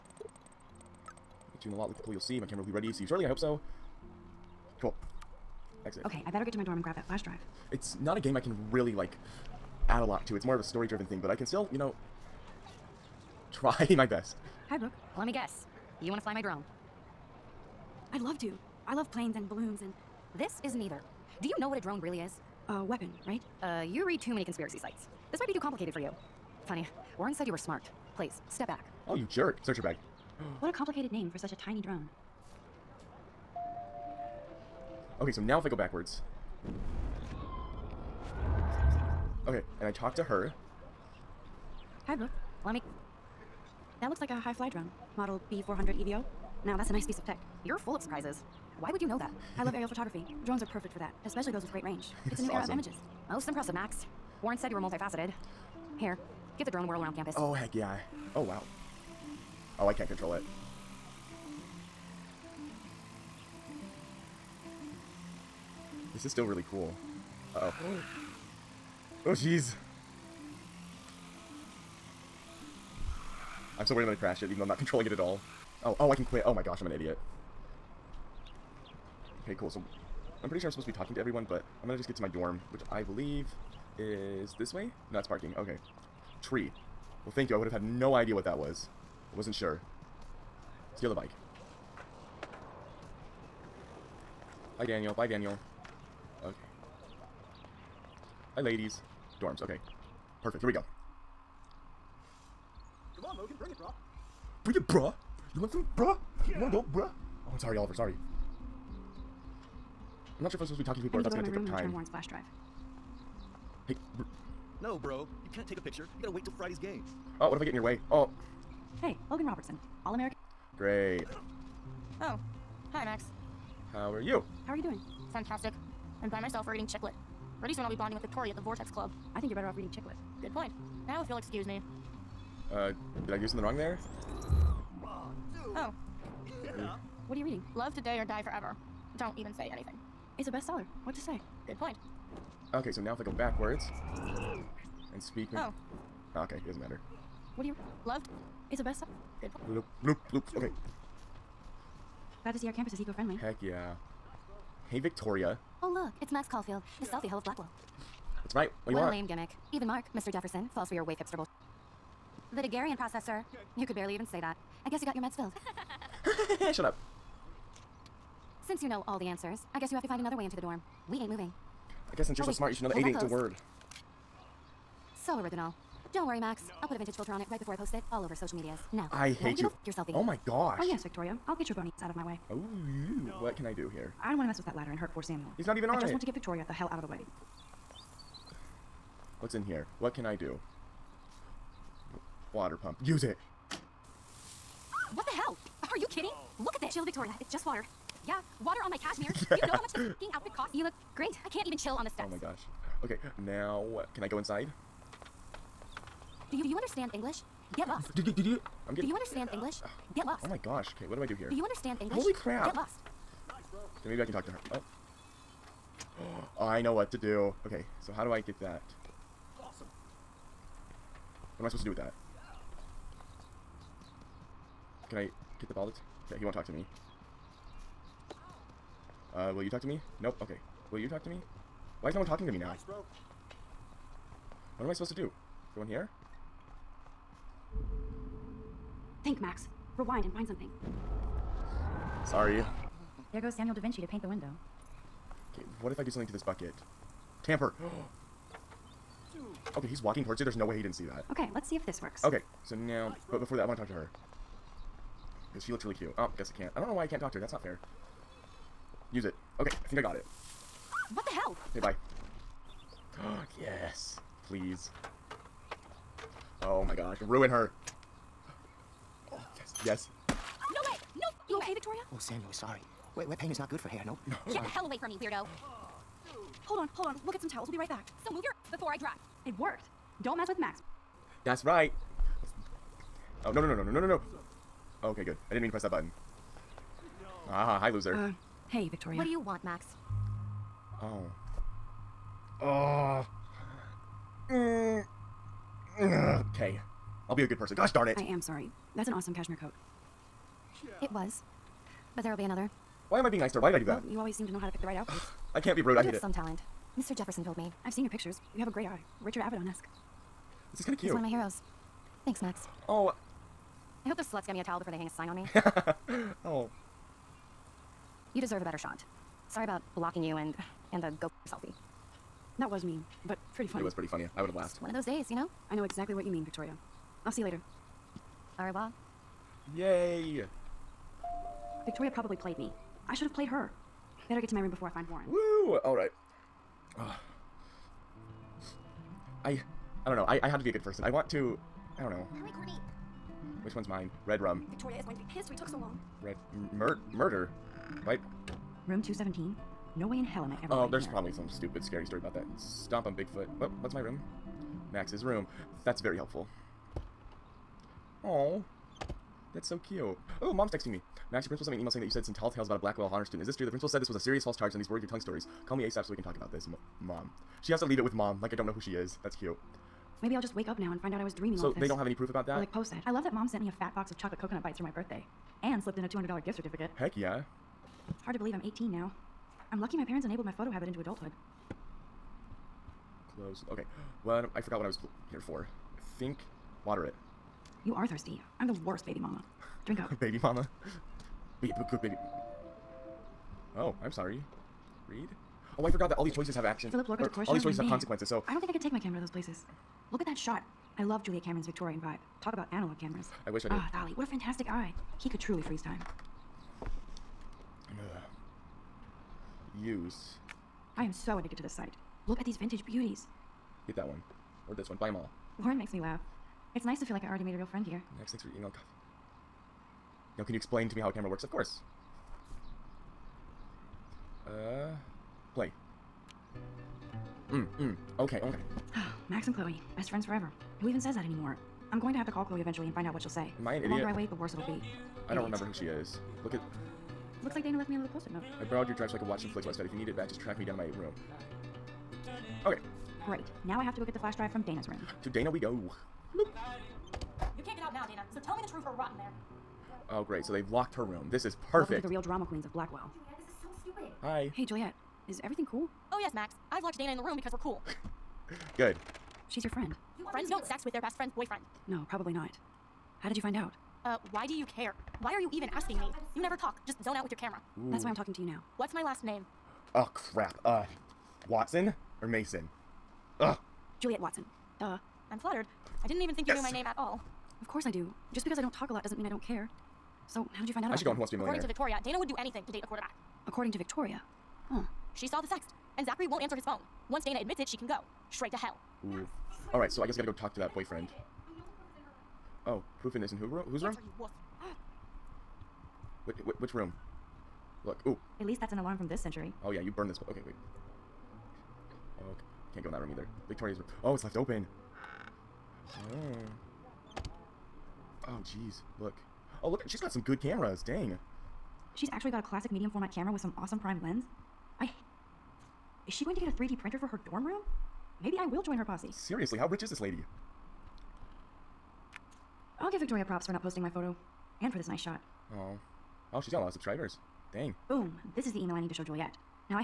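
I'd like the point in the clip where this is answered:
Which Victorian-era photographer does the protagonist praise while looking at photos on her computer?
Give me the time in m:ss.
6:41.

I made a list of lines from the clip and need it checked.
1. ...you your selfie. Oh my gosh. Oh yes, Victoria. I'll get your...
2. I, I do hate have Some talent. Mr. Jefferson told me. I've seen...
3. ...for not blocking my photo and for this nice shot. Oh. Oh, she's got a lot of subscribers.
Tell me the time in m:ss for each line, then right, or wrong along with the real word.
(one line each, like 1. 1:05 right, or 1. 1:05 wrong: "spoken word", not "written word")
1. 2:59 right
2. 5:05 right
3. 8:43 wrong: "posting", not "blocking".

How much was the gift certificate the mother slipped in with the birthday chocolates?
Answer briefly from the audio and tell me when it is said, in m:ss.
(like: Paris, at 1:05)
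$200, at 6:16.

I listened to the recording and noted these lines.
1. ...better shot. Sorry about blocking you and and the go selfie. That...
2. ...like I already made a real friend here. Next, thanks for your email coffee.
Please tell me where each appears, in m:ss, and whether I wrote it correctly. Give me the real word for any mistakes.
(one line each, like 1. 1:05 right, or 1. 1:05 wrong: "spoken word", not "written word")
1. 5:18 right
2. 6:57 right.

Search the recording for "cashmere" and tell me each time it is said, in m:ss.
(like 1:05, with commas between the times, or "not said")
3:18, 4:59.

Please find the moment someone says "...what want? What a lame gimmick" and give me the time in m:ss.
2:38.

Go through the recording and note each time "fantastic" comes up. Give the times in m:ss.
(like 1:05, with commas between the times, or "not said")
2:05, 6:44.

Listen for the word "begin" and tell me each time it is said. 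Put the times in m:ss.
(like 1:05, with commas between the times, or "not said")
not said.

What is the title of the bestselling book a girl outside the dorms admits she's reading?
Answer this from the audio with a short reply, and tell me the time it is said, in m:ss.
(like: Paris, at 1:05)
Love Today or Die Forever, at 2:17.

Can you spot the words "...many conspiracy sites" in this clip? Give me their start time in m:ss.
0:24.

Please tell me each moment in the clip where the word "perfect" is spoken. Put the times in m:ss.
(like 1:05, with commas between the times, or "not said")
0:50, 1:40, 7:31.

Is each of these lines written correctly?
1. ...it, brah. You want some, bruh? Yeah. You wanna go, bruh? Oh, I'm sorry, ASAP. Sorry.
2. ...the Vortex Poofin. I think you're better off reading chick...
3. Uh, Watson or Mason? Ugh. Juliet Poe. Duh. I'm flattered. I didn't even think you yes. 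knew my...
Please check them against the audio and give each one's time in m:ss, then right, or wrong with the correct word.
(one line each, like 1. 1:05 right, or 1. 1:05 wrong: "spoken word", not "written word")
1. 1:44 wrong: "Oliver", not "ASAP"
2. 2:08 wrong: "Club", not "Poofin"
3. 7:50 wrong: "Watson", not "Poe".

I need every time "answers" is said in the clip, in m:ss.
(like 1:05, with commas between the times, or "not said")
2:49, 8:06.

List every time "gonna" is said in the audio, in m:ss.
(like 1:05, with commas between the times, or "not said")
1:14, 1:21, 1:51.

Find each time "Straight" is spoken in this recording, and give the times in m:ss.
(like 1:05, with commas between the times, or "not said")
8:08.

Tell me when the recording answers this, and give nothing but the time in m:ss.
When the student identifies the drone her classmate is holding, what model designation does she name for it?
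0:45.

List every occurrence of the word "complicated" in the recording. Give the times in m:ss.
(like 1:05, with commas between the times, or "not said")
0:25, 0:30.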